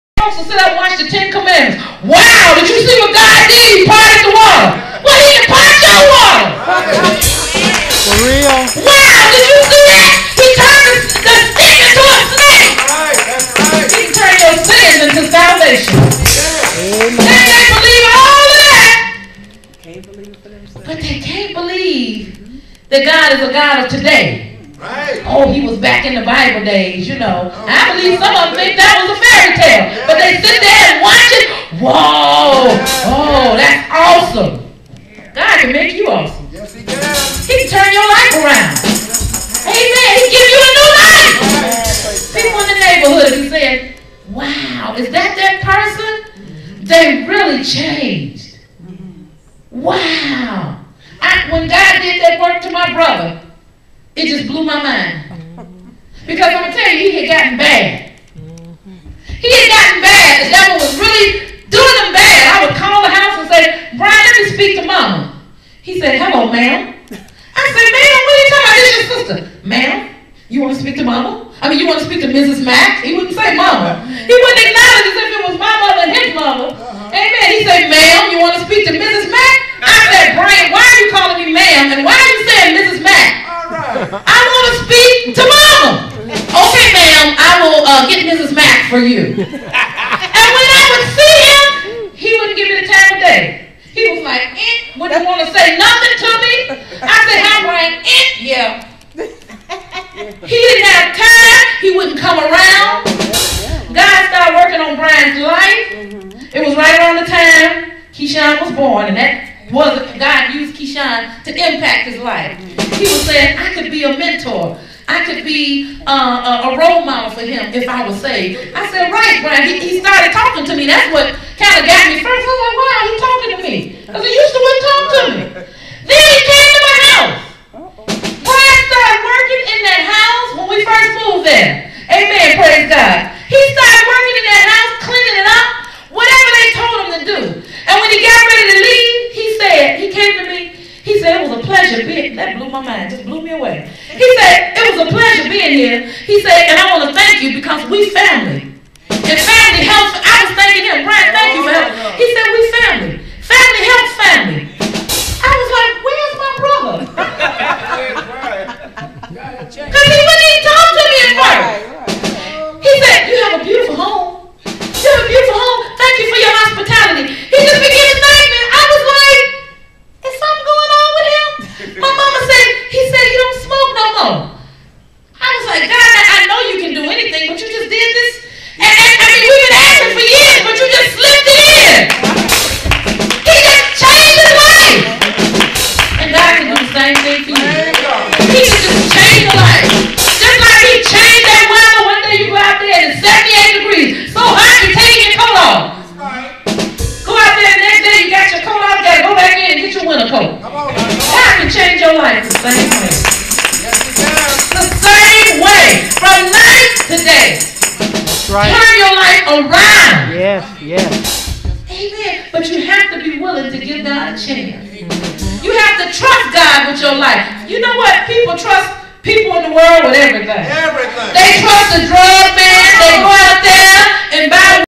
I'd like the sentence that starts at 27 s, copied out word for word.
Oh, I believe some of them think that was a fairy tale sit there and watch it.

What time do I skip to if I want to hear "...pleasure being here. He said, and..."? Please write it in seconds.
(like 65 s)
145 s.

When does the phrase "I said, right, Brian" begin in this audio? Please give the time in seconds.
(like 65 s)
118 s.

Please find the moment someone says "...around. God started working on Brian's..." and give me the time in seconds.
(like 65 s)
102 s.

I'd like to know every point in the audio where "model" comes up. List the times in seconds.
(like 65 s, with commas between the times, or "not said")
117 s.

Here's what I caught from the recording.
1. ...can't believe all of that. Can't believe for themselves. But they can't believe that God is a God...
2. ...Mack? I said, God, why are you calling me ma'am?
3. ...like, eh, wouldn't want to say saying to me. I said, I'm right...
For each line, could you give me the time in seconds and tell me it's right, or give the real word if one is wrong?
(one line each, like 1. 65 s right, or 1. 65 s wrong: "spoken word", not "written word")
1. 17 s right
2. 79 s wrong: "Brian", not "God"
3. 94 s wrong: "nothing", not "saying".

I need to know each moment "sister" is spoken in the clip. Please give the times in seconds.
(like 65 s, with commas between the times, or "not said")
69 s.